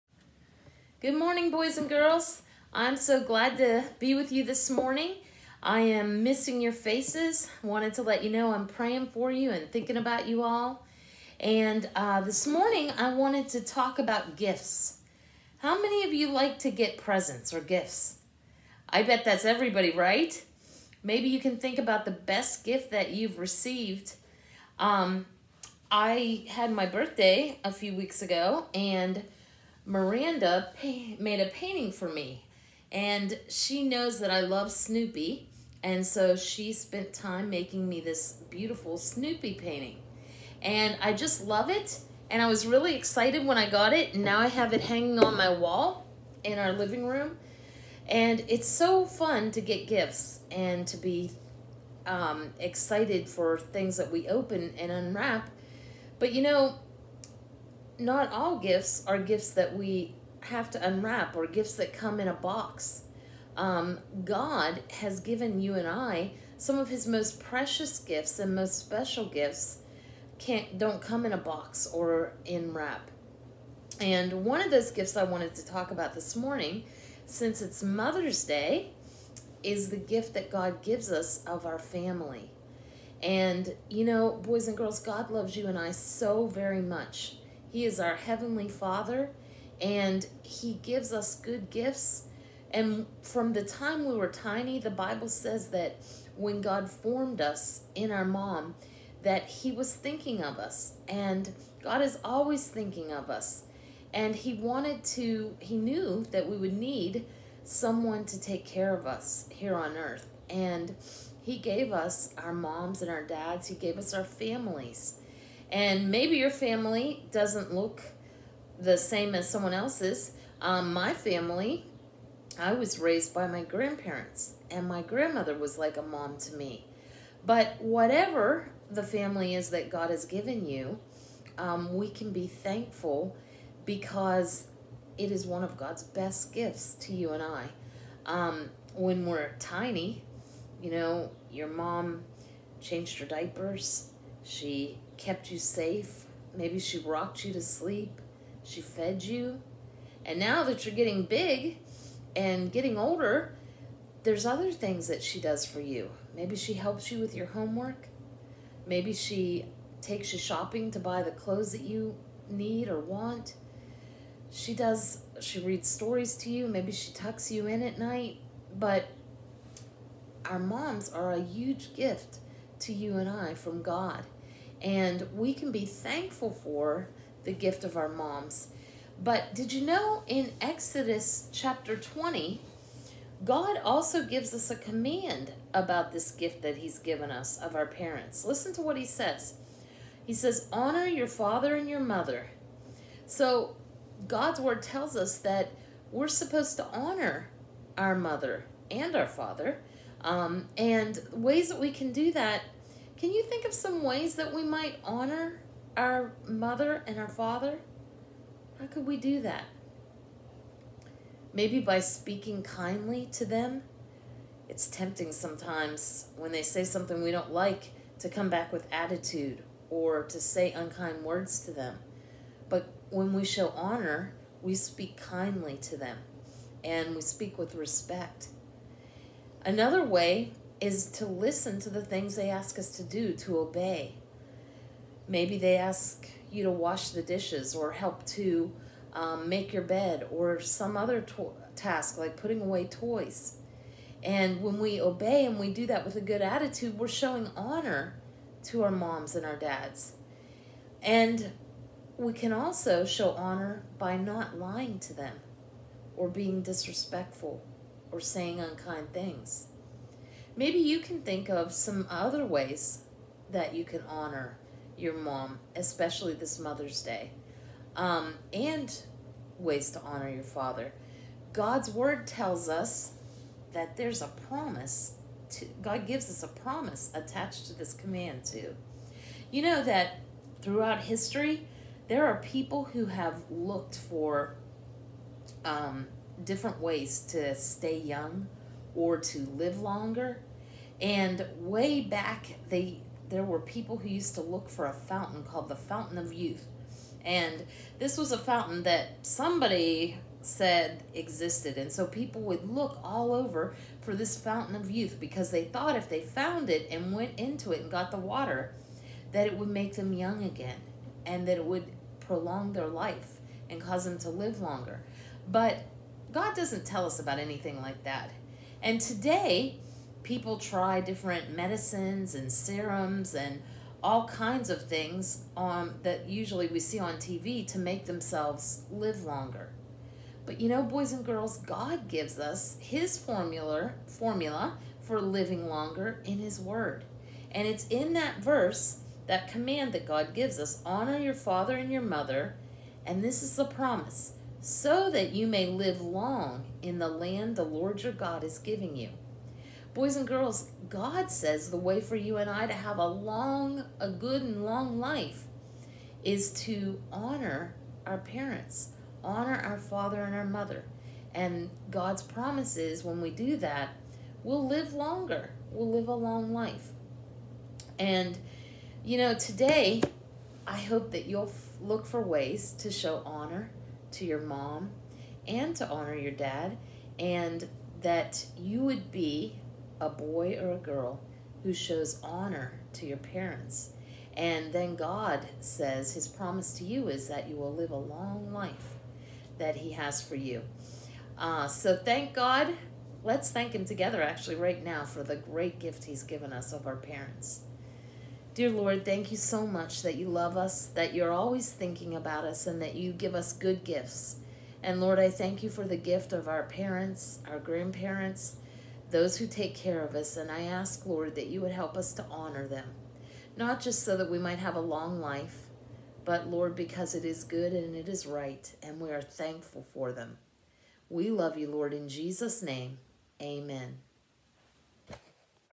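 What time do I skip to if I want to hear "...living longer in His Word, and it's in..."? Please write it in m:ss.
5:35.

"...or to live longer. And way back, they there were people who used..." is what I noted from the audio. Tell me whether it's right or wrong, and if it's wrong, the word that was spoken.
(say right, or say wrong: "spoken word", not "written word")
right.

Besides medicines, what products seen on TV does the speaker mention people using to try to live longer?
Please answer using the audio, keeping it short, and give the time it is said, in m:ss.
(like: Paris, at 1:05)
Serums, at 5:22.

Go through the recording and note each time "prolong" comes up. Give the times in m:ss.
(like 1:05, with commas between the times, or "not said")
5:12.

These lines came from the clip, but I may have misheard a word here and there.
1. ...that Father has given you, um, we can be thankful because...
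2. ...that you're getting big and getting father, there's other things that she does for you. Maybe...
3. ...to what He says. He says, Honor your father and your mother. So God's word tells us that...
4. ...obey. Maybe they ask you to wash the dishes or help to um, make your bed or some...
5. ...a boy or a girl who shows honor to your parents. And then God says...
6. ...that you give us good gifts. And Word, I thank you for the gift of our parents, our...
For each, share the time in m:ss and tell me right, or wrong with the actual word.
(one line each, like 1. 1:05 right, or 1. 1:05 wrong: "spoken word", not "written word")
1. 2:09 wrong: "God", not "Father"
2. 2:30 wrong: "older", not "father"
3. 3:08 right
4. 3:53 right
5. 6:19 right
6. 6:42 wrong: "Lord", not "Word".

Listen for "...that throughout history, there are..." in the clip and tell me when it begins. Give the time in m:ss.
4:39.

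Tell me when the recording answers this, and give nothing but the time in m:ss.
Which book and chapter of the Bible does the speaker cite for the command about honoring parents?
3:00.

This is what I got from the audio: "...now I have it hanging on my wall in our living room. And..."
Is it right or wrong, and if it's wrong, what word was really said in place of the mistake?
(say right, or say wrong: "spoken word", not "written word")
right.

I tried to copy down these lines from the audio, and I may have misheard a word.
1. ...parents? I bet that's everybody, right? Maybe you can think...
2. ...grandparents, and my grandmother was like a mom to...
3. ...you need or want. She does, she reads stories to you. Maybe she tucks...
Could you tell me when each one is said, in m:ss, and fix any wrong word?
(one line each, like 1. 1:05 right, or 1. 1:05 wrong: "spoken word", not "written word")
1. 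0:17 wrong: "gifts", not "parents"
2. 2:03 right
3. 2:41 right.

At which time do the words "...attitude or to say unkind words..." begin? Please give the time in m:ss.
3:38.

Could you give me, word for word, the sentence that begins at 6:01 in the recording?
And God's promise is when we do that, we'll live longer.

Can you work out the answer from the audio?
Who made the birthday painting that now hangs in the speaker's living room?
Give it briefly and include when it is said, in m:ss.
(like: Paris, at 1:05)
Miranda, at 0:29.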